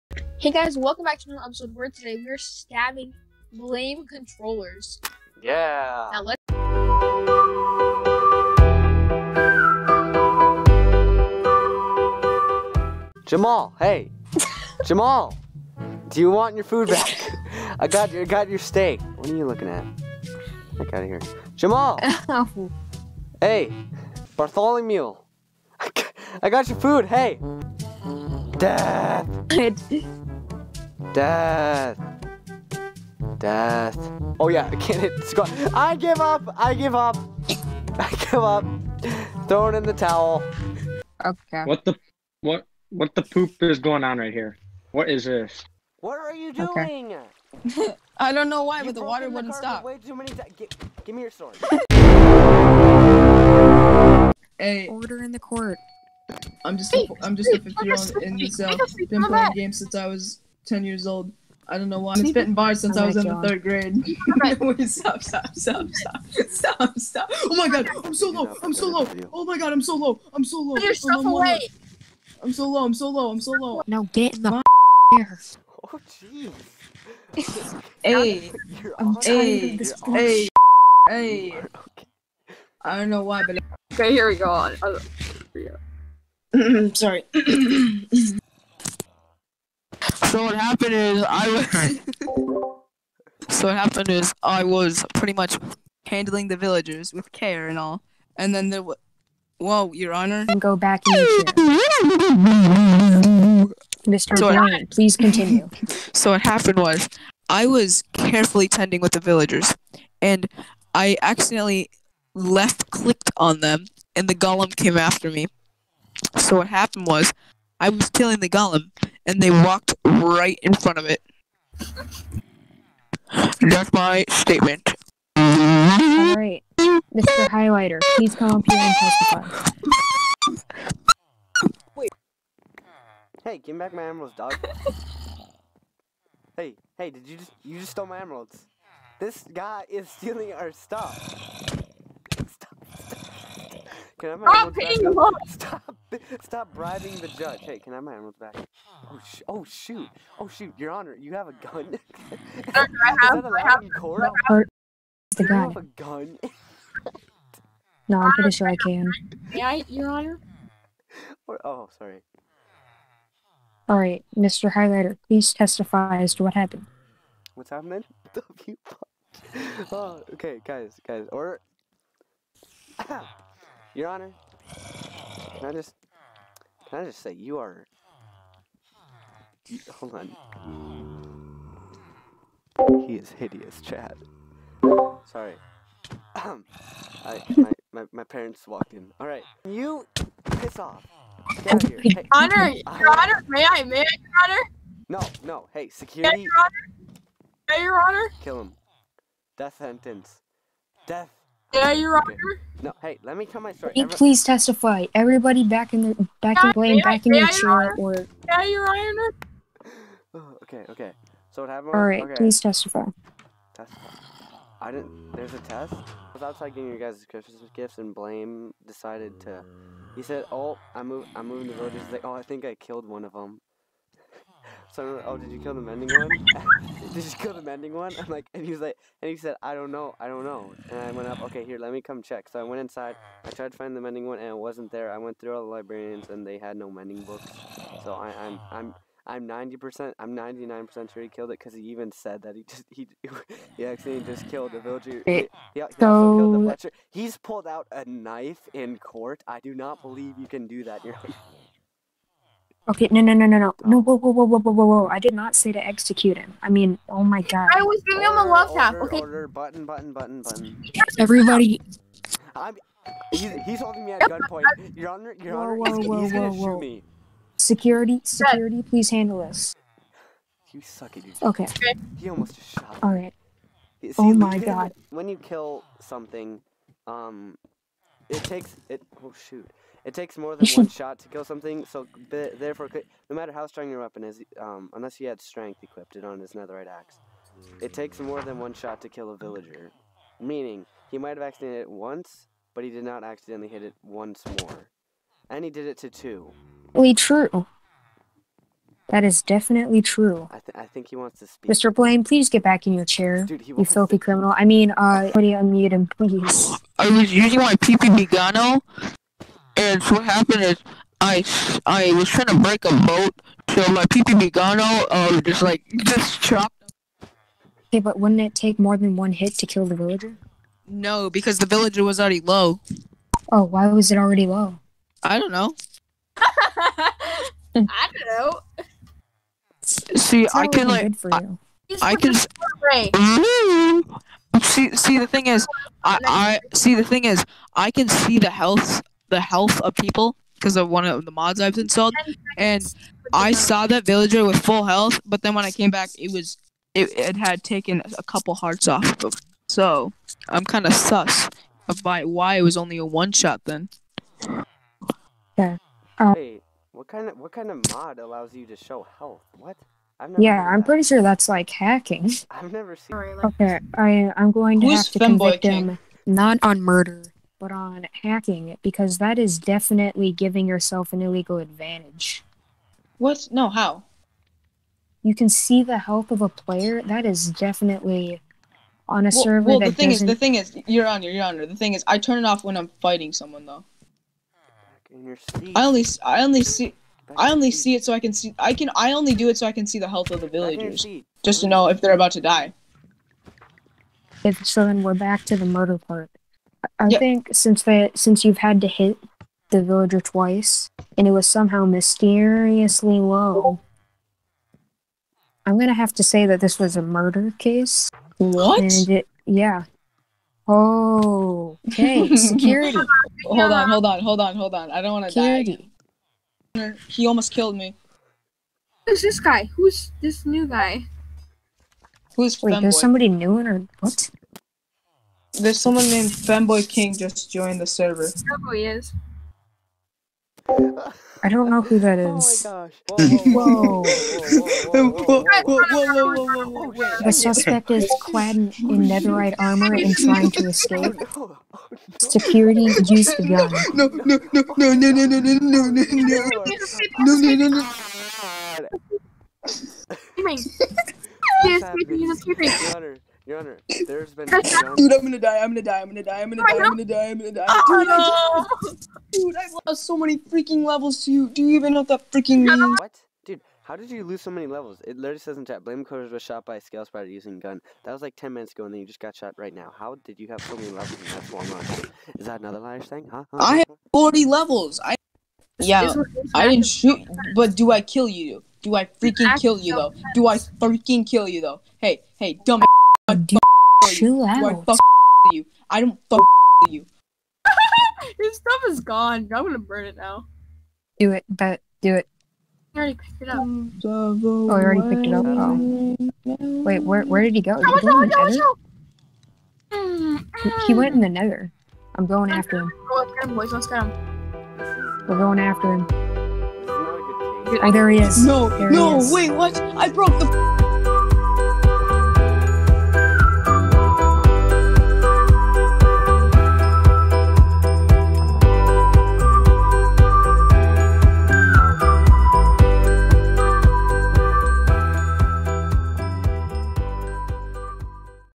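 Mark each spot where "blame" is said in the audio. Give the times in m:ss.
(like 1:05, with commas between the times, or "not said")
0:03, 3:38, 7:45.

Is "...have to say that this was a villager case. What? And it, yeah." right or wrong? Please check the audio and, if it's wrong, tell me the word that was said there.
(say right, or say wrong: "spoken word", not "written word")
wrong: "murder", not "villager".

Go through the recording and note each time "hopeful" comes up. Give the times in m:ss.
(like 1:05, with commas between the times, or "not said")
not said.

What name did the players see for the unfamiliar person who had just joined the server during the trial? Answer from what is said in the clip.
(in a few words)
Fanboy King.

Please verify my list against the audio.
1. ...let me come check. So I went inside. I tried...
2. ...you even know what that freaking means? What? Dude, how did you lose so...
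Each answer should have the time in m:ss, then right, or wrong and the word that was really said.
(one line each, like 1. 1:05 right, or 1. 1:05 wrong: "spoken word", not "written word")
1. 3:51 right
2. 7:41 right.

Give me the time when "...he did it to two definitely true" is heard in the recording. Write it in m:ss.
4:55.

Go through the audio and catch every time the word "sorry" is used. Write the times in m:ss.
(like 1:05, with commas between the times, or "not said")
1:26, 2:41, 3:05.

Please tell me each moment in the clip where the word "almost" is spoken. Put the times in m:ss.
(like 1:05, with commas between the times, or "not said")
4:32, 6:57.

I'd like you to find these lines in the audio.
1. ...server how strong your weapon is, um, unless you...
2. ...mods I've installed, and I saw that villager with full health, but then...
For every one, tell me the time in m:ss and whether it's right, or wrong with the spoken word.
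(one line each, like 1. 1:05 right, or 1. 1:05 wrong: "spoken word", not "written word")
1. 4:43 wrong: "matter", not "server"
2. 5:41 right.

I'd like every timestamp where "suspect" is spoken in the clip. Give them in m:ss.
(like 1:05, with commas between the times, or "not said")
7:17.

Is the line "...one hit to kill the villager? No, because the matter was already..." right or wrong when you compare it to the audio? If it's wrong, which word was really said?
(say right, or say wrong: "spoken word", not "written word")
wrong: "villager", not "matter".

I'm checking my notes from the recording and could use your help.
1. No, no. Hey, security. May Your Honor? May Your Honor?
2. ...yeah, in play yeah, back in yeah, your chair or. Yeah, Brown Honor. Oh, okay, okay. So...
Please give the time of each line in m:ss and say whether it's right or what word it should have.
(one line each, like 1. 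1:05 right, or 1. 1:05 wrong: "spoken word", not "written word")
1. 3:15 right
2. 3:26 wrong: "Your", not "Brown".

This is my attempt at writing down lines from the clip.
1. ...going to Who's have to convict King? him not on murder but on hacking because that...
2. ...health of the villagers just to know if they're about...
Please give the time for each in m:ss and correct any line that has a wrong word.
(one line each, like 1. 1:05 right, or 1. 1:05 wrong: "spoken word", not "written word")
1. 6:04 right
2. 6:30 right.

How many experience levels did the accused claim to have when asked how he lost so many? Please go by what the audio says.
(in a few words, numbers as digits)
40.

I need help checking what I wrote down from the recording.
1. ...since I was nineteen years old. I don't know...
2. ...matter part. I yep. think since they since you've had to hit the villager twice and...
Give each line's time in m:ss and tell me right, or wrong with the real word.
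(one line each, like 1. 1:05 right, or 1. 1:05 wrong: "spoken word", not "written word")
1. 0:59 wrong: "ten", not "nineteen"
2. 6:35 wrong: "murder", not "matter".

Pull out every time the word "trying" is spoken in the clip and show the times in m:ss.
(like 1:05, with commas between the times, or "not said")
5:12, 7:20.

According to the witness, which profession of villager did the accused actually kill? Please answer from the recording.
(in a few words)
Fletcher.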